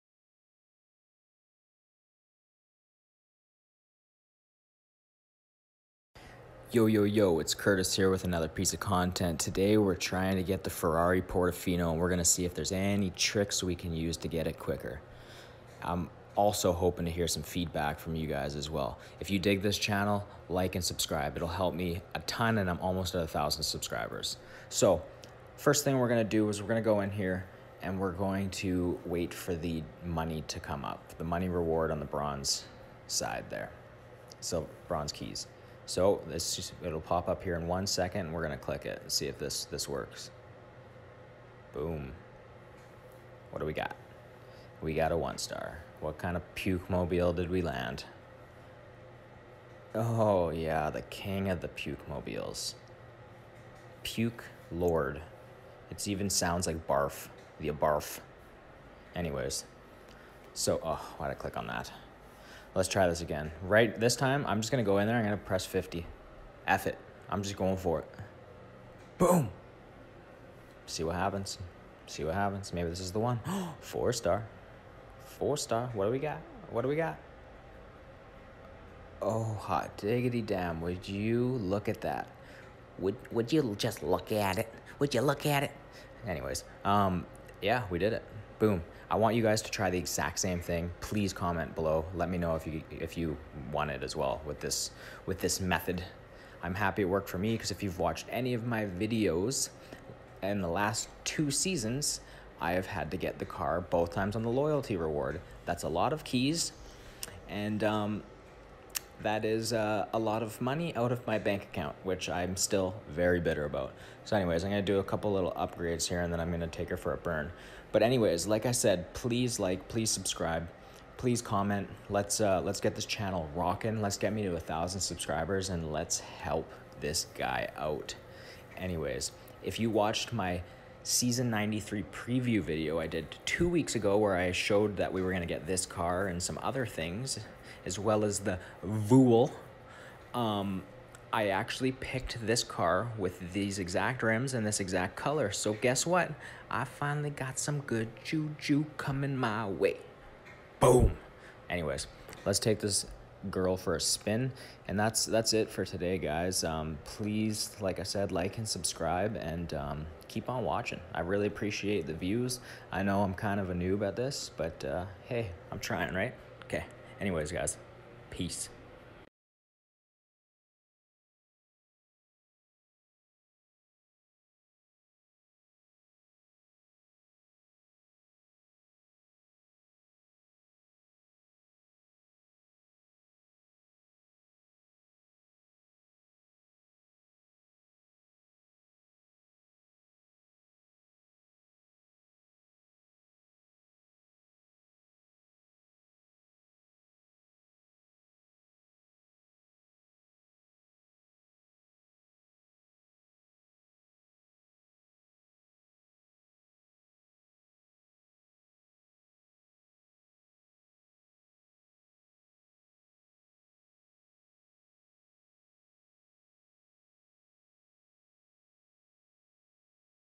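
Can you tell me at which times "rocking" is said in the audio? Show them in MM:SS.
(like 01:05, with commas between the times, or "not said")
02:03.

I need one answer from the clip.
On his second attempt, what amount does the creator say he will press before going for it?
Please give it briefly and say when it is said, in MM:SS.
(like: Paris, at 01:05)
50, at 01:05.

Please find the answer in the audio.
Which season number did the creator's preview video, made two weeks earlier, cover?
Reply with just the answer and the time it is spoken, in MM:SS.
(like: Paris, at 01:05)
93, at 02:11.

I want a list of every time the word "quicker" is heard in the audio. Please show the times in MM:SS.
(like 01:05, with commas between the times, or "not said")
00:14.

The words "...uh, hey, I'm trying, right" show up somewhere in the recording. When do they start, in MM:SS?
02:44.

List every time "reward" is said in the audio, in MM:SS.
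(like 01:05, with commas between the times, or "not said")
00:31, 01:44.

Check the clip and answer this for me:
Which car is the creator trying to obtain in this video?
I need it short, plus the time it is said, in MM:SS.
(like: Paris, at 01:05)
Ferrari Portofino, at 00:10.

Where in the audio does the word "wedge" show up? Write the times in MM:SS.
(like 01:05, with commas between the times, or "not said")
not said.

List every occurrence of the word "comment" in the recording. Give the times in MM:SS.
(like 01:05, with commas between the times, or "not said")
01:31, 02:01.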